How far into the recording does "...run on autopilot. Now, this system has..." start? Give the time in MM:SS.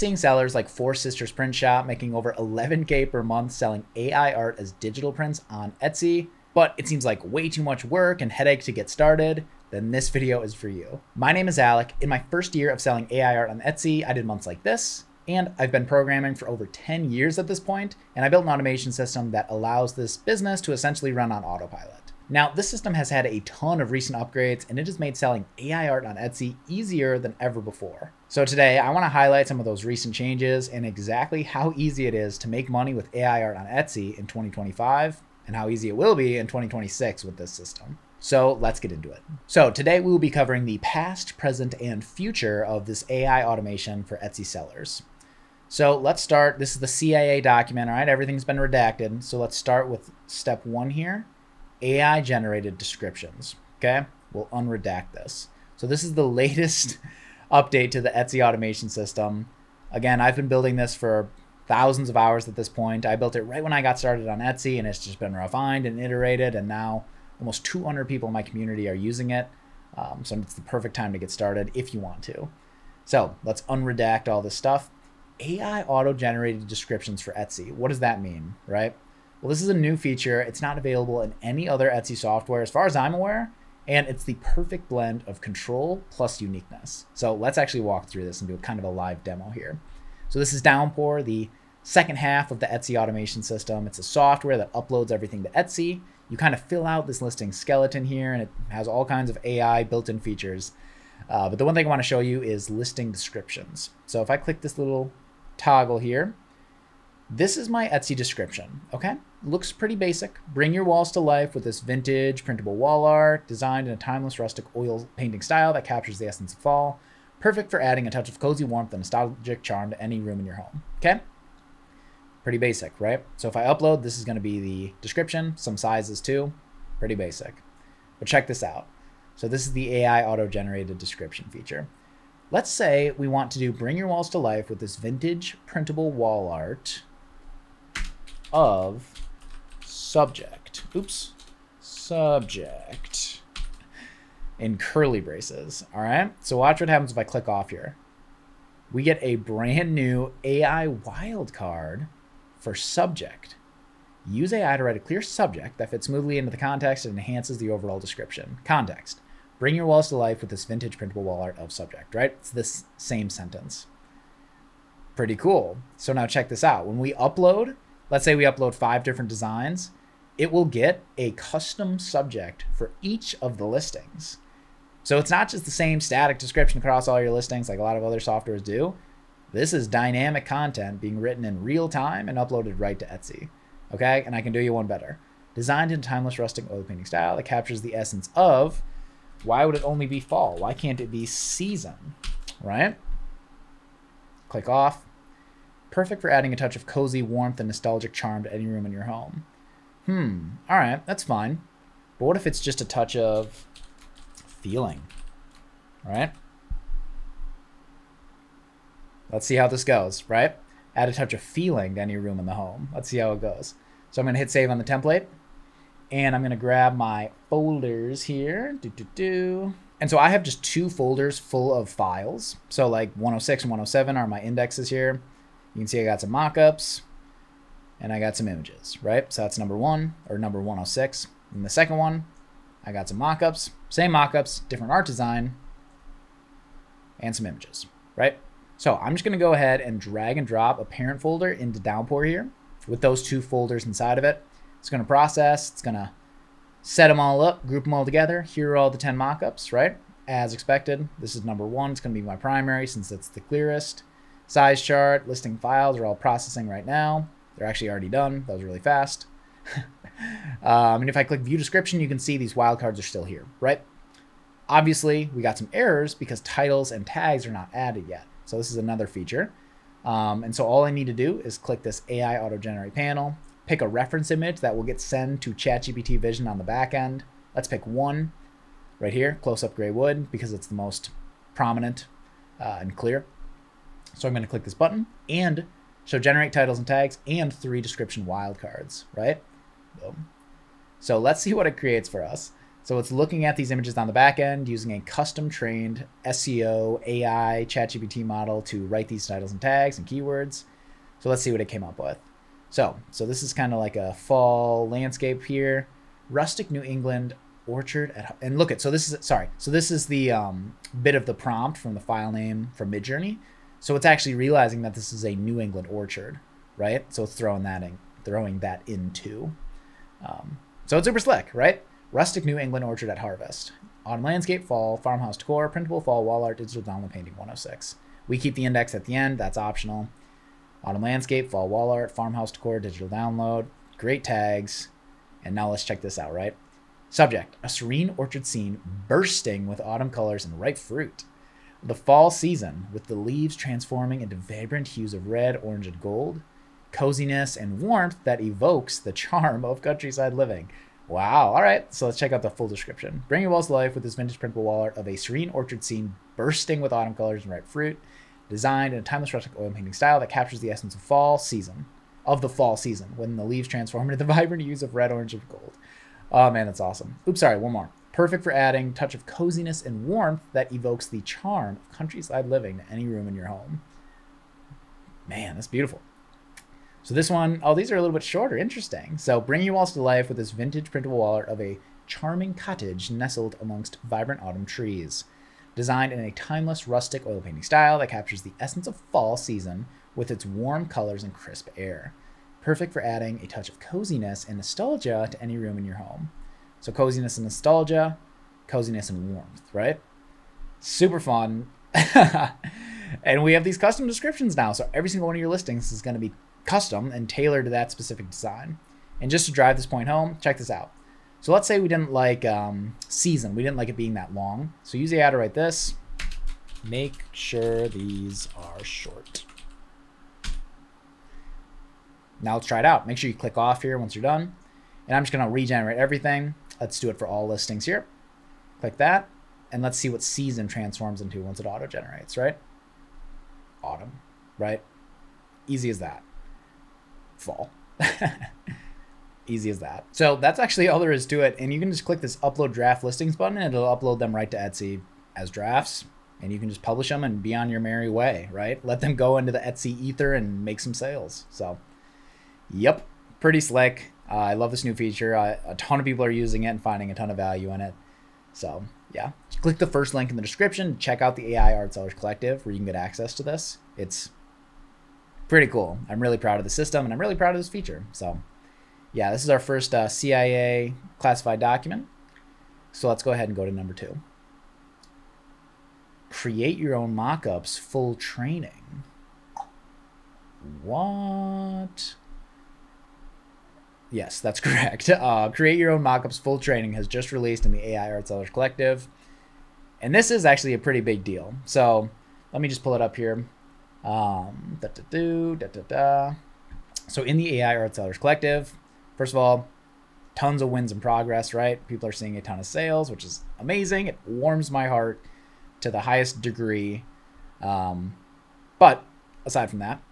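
00:21.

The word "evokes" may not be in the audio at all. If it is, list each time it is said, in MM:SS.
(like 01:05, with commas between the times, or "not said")
05:48, 06:10.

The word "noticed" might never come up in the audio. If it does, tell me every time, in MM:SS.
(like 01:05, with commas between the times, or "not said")
not said.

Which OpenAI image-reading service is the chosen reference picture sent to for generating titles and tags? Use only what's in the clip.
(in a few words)
ChatGPT Vision.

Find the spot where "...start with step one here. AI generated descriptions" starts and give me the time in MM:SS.
00:49.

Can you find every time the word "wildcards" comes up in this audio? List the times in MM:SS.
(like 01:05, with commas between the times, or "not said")
02:30, 04:22, 04:48.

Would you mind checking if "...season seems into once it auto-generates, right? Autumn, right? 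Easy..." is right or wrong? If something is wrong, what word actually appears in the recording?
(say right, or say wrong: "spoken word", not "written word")
wrong: "transforms", not "seems".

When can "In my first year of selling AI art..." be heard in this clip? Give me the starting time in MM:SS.
00:11.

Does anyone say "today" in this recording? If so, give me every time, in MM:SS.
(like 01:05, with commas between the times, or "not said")
00:28, 00:39.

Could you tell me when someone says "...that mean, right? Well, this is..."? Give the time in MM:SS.
01:17.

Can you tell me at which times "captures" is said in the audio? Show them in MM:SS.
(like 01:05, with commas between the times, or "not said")
01:55, 03:07, 06:00, 06:28.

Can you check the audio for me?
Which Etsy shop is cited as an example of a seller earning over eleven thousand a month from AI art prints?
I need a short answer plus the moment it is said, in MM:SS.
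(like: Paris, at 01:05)
Four Sisters Print Shop, at 00:00.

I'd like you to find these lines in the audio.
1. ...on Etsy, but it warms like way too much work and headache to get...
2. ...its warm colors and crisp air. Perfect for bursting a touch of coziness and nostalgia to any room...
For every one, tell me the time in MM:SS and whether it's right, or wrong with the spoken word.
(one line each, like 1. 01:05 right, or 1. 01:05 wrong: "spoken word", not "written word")
1. 00:05 wrong: "seems", not "warms"
2. 06:30 wrong: "adding", not "bursting".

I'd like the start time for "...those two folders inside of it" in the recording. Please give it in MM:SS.
04:03.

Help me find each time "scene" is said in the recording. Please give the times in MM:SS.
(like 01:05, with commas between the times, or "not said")
05:38, 05:55.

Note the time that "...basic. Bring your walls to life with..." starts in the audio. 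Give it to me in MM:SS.
01:49.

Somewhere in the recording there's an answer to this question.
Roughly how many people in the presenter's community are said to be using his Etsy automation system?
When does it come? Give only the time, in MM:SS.
01:07.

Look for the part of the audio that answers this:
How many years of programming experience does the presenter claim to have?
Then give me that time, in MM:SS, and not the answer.
00:16.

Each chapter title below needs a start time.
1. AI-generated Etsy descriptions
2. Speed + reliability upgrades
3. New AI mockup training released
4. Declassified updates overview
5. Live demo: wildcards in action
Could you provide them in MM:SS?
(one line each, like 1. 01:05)
1. 01:14
2. 08:19
3. 06:39
4. 00:39
5. 02:44.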